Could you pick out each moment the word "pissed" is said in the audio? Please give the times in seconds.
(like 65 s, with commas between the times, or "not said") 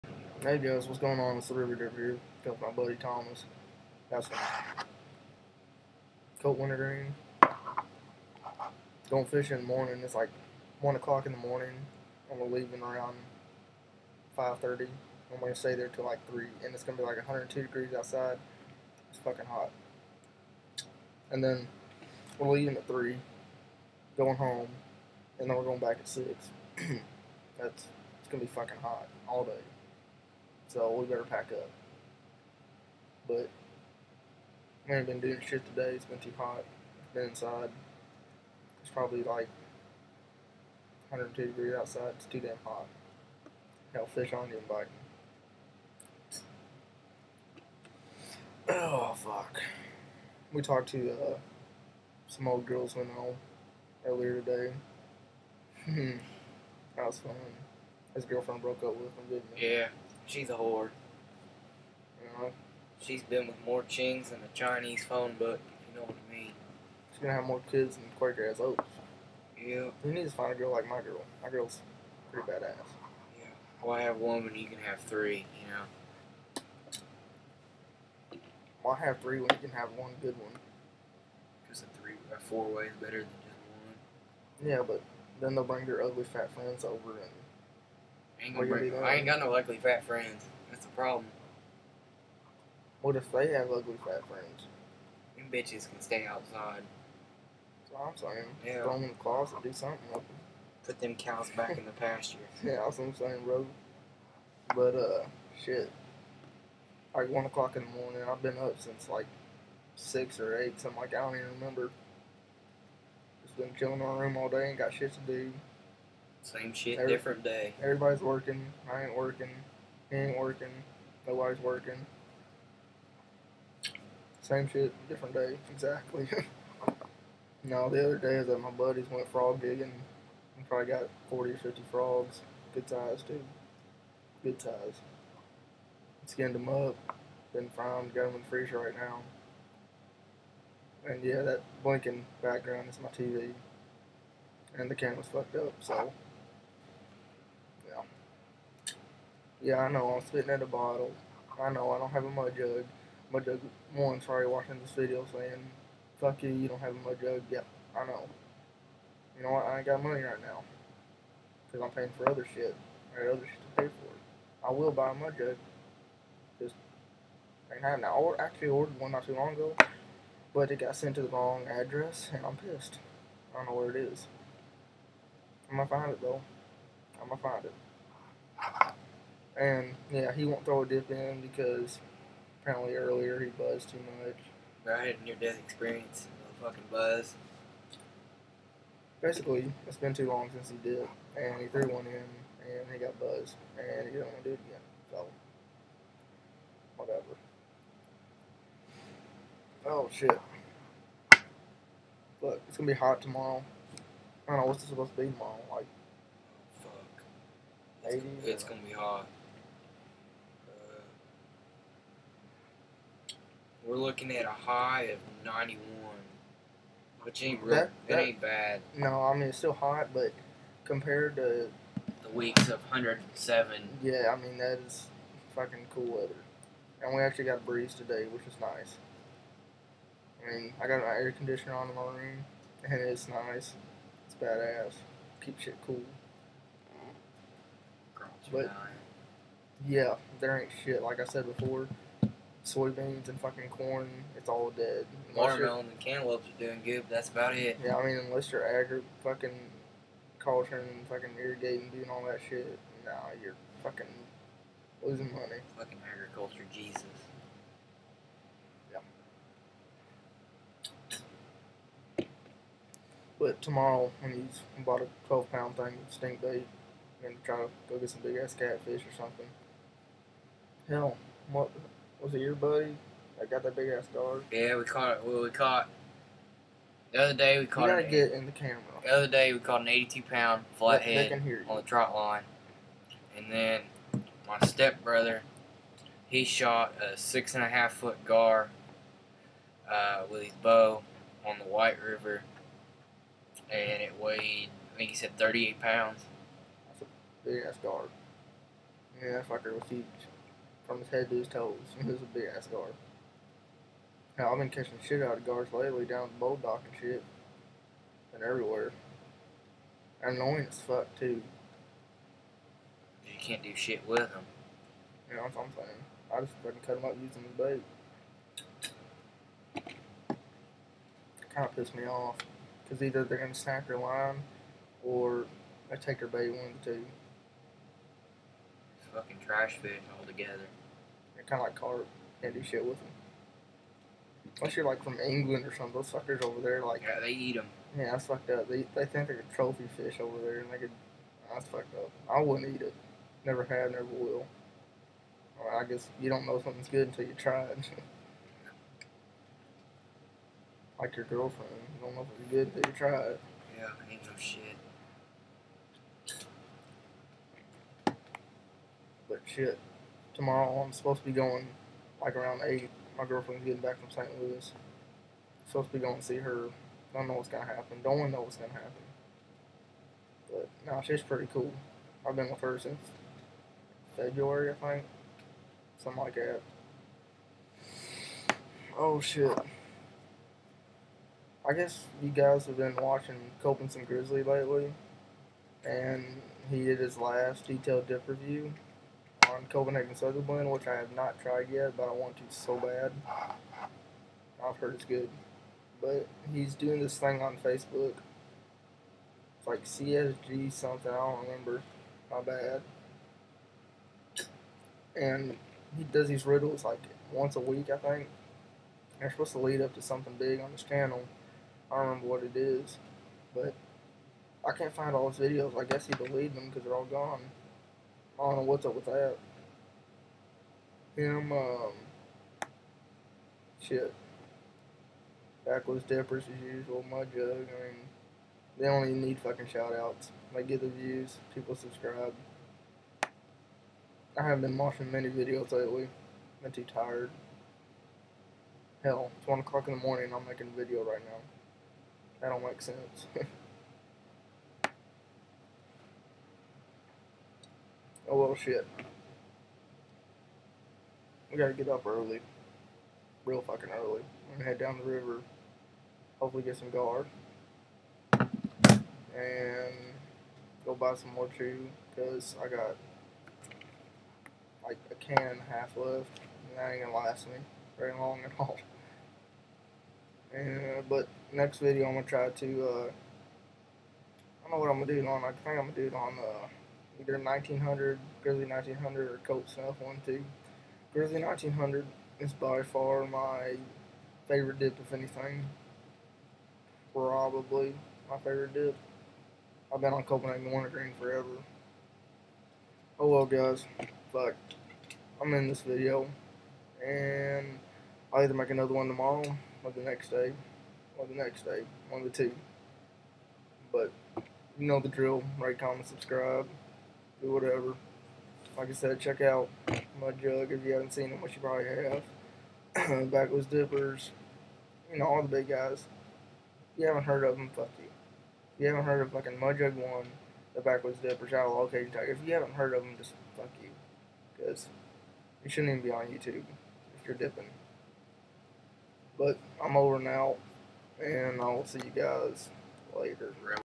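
172 s, 321 s.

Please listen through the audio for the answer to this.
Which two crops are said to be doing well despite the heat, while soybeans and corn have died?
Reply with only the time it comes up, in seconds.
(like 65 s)
245 s.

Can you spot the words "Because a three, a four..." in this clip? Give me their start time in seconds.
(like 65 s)
81 s.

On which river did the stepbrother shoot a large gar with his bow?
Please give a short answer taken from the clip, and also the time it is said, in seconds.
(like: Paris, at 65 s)
White River, at 291 s.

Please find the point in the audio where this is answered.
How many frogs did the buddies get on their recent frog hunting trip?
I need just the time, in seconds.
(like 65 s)
131 s.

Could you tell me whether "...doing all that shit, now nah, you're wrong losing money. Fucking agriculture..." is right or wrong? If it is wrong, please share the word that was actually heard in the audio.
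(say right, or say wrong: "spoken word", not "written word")
wrong: "fucking", not "wrong".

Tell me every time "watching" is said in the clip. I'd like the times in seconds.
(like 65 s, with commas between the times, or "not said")
154 s, 382 s, 434 s.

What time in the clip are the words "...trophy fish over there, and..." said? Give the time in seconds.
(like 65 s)
339 s.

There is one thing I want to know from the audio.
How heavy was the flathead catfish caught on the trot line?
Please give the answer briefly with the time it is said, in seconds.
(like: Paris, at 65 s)
82 pounds, at 279 s.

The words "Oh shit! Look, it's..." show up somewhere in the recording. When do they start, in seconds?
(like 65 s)
199 s.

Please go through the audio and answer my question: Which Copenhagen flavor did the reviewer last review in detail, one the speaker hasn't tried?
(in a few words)
Southern Blend.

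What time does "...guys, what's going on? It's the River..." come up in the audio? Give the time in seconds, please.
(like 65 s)
0 s.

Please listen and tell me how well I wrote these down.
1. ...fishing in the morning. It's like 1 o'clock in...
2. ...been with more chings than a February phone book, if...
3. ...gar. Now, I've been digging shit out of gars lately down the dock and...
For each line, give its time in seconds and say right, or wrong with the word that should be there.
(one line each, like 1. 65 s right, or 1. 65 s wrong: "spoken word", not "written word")
1. 9 s right
2. 63 s wrong: "Chinese", not "February"
3. 302 s wrong: "catching", not "digging".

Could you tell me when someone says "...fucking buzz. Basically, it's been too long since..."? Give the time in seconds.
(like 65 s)
186 s.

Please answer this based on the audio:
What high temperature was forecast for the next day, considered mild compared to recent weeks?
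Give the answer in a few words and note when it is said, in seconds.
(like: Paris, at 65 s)
91, at 215 s.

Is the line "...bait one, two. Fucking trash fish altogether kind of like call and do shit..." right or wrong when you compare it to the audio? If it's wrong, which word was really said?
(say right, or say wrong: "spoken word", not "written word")
right.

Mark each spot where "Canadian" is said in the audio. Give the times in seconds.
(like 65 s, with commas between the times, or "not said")
not said.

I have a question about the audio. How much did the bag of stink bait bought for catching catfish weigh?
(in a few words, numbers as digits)
12 pounds.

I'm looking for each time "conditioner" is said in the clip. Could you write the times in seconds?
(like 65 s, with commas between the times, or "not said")
231 s.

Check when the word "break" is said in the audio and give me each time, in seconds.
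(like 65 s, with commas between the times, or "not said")
88 s.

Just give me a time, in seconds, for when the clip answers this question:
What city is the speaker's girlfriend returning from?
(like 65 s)
364 s.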